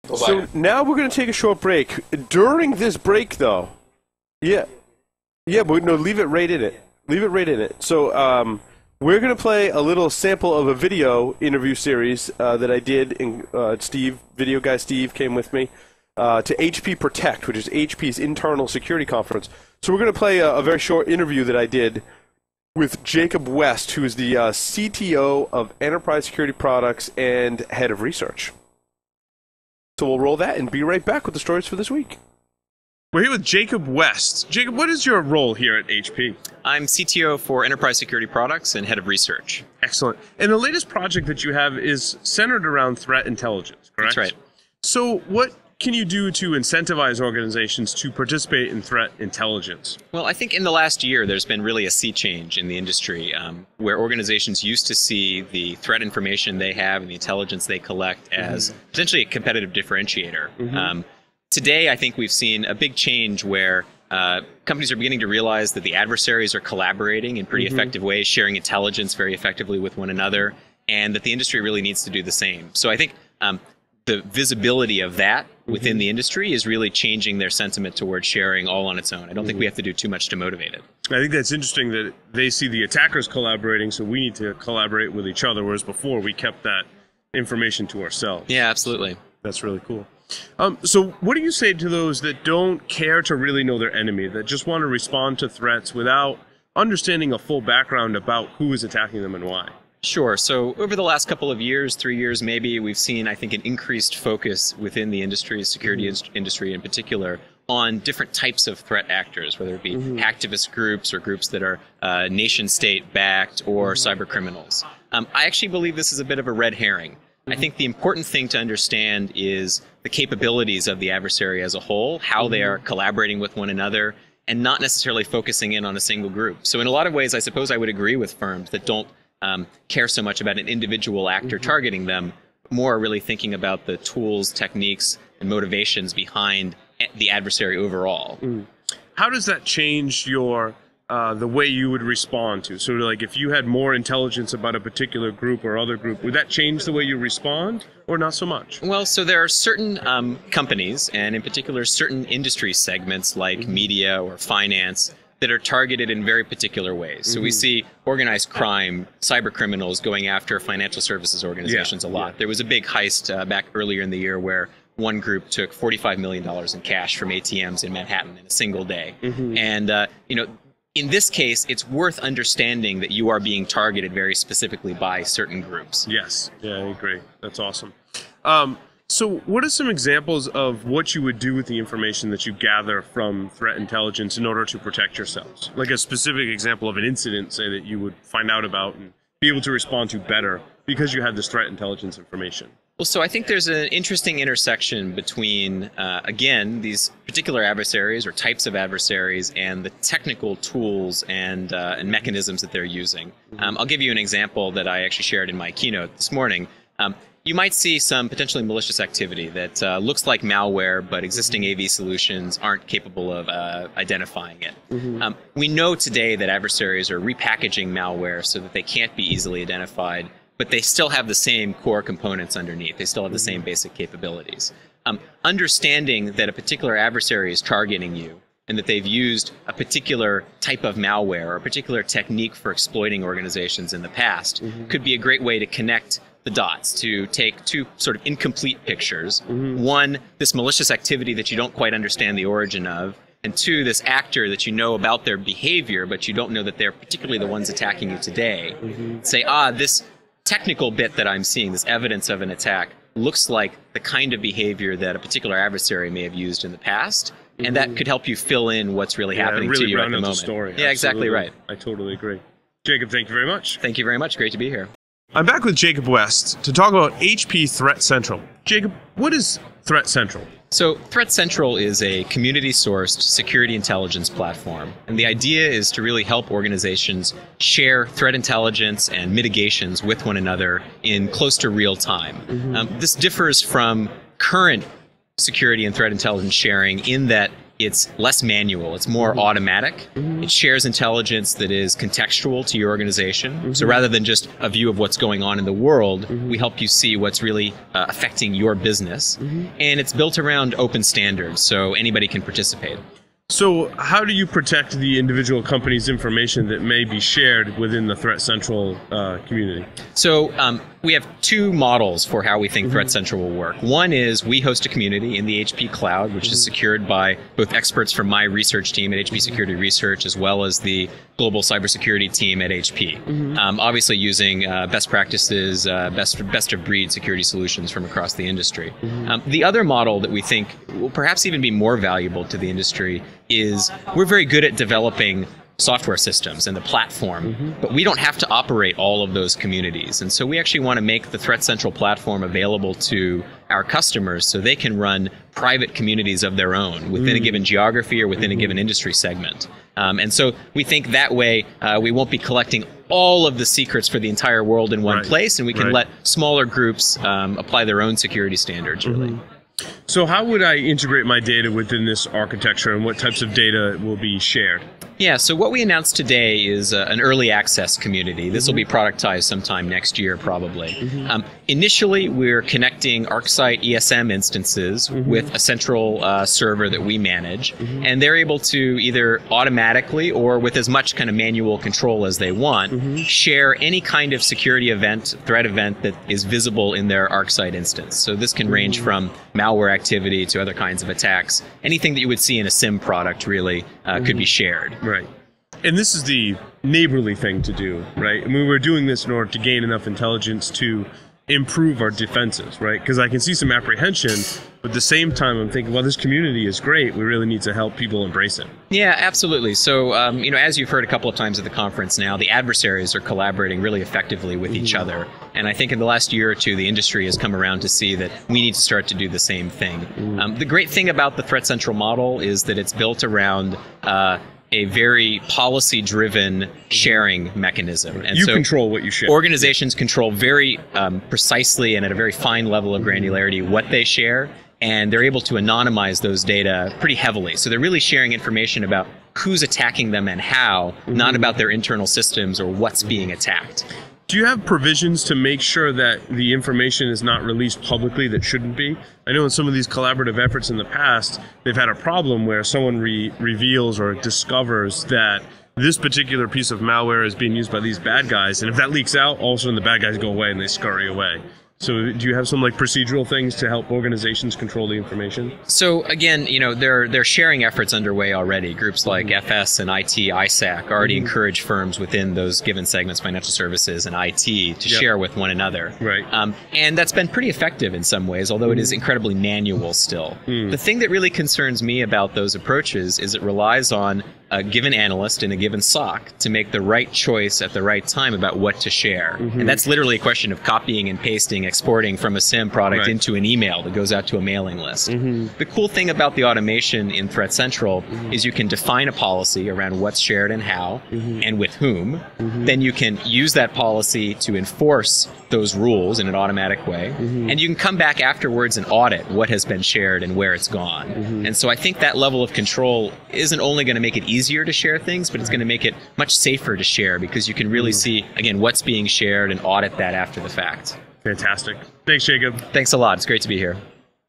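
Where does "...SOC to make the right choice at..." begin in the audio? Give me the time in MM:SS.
08:05.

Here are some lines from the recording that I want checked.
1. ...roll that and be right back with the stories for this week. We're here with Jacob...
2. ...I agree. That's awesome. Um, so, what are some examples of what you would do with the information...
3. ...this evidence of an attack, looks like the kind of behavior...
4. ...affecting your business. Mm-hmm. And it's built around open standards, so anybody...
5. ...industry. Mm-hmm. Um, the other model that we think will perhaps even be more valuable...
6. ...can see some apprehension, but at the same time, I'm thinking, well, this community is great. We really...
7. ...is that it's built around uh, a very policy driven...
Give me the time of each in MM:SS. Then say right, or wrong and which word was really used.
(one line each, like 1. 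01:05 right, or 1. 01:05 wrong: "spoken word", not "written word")
1. 00:30 right
2. 02:56 right
3. 04:11 right
4. 04:58 right
5. 05:28 right
6. 06:43 right
7. 07:02 right.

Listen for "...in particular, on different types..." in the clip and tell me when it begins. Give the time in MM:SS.
01:46.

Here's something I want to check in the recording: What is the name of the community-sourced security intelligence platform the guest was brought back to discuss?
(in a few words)
HP Threat Central.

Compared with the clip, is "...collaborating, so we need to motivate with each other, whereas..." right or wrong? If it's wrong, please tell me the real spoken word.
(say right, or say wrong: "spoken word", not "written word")
wrong: "collaborate", not "motivate".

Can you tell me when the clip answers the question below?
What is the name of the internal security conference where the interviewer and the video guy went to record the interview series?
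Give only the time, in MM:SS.
00:16.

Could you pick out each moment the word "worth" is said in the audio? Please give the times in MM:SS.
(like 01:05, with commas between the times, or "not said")
02:51.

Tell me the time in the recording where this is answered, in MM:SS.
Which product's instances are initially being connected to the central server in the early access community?
06:13.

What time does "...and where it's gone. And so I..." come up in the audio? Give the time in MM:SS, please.
08:30.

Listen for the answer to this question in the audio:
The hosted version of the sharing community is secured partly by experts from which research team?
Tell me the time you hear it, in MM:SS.
05:19.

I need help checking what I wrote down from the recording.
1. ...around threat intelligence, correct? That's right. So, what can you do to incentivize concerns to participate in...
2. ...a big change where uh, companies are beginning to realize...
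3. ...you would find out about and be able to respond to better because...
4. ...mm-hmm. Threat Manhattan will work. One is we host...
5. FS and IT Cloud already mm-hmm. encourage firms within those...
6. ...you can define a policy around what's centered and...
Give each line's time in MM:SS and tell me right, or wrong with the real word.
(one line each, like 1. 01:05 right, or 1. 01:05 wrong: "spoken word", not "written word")
1. 00:42 wrong: "organizations", not "concerns"
2. 01:02 right
3. 03:07 right
4. 05:12 wrong: "Central", not "Manhattan"
5. 07:49 wrong: "ISAC", not "Cloud"
6. 08:18 wrong: "shared", not "centered".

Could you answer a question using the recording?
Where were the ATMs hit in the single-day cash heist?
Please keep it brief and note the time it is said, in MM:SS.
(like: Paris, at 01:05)
Manhattan, at 02:47.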